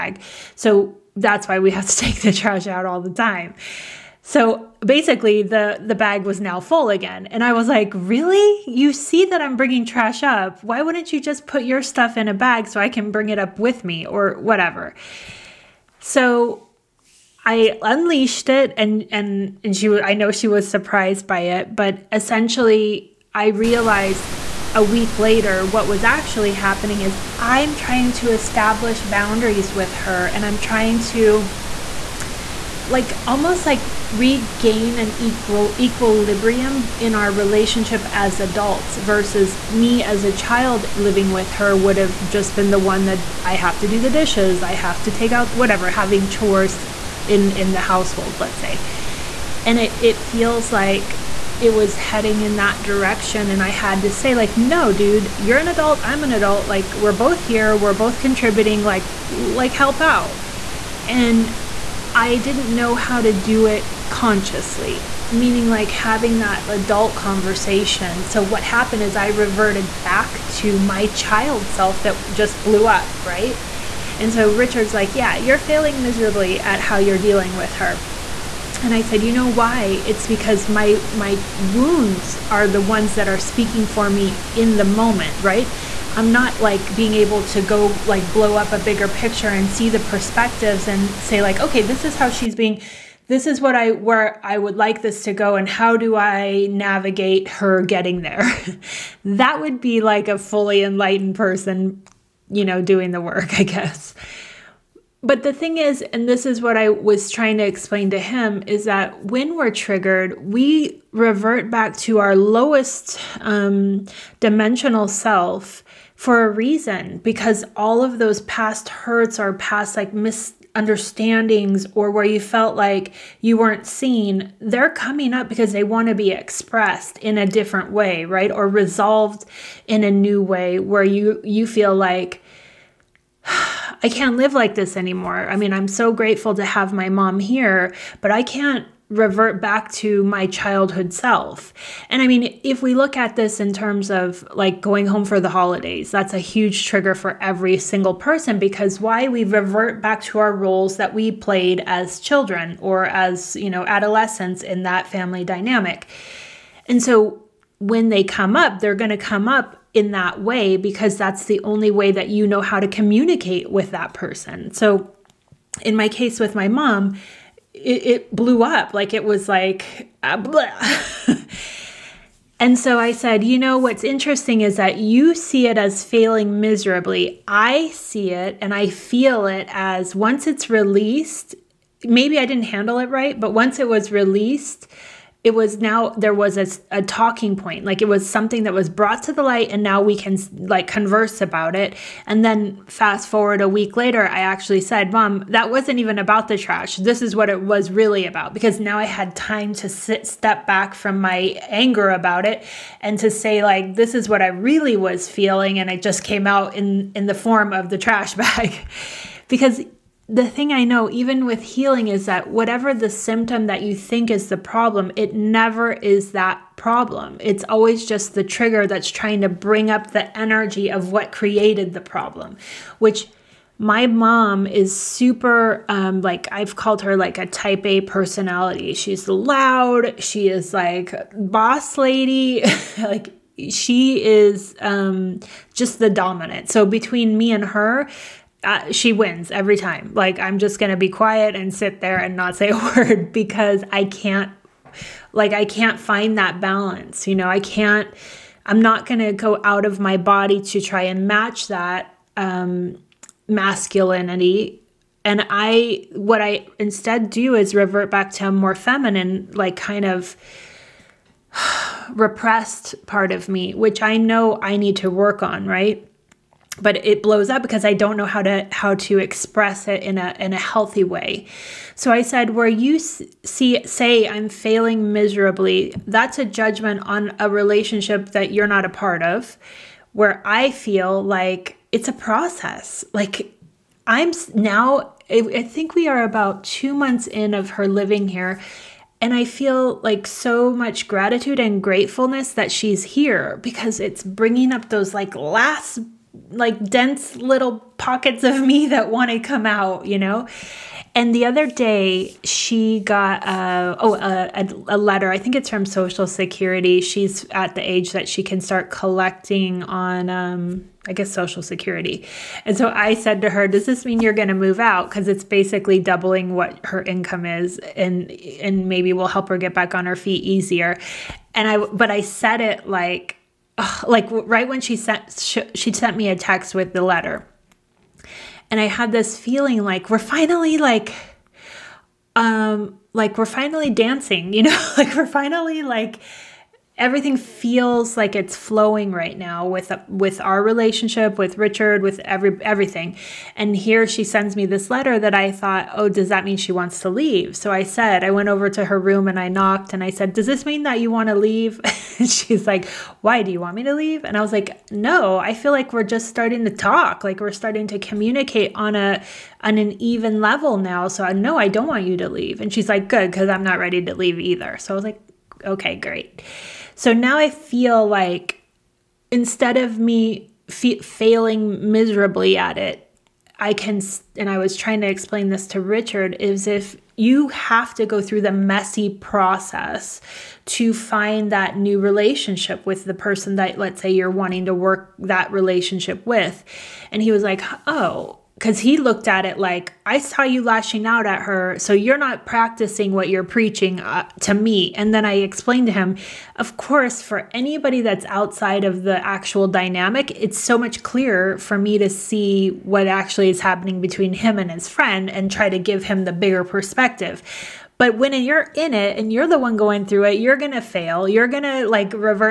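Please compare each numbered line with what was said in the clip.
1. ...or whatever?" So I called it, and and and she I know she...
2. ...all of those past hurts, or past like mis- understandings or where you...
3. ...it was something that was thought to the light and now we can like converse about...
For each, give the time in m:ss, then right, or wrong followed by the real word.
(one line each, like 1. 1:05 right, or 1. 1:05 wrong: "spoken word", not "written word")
1. 0:14 wrong: "unleashed", not "called"
2. 1:57 right
3. 3:08 wrong: "brought", not "thought".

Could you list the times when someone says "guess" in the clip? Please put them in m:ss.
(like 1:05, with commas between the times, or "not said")
1:43, 5:11.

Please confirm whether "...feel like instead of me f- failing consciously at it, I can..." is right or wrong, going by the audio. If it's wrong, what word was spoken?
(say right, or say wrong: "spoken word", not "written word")
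wrong: "miserably", not "consciously".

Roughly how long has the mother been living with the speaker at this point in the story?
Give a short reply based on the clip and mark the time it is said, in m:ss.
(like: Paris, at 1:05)
2 months, at 4:46.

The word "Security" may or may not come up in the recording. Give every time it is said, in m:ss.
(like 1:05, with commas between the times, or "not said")
5:06, 5:11.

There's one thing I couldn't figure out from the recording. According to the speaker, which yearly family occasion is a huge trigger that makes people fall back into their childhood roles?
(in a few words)
The holidays.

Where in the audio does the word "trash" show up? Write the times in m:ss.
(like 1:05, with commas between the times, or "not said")
0:02, 0:09, 3:16, 3:27.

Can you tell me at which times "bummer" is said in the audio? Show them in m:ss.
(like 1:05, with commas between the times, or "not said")
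not said.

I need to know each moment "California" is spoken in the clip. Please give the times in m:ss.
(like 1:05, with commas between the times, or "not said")
not said.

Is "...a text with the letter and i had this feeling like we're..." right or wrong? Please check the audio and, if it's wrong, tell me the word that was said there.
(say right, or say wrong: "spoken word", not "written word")
right.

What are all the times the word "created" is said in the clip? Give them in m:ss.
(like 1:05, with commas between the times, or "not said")
3:41.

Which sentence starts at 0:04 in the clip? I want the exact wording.
So basically, the the bag was now full again, and I was like, "Really?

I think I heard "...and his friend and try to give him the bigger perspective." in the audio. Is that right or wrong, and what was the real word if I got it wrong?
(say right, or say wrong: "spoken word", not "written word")
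right.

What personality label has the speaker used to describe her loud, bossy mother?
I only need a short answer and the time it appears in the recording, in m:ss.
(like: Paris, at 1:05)
Type A, at 3:47.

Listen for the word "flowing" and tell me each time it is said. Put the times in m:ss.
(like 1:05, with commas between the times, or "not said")
5:38.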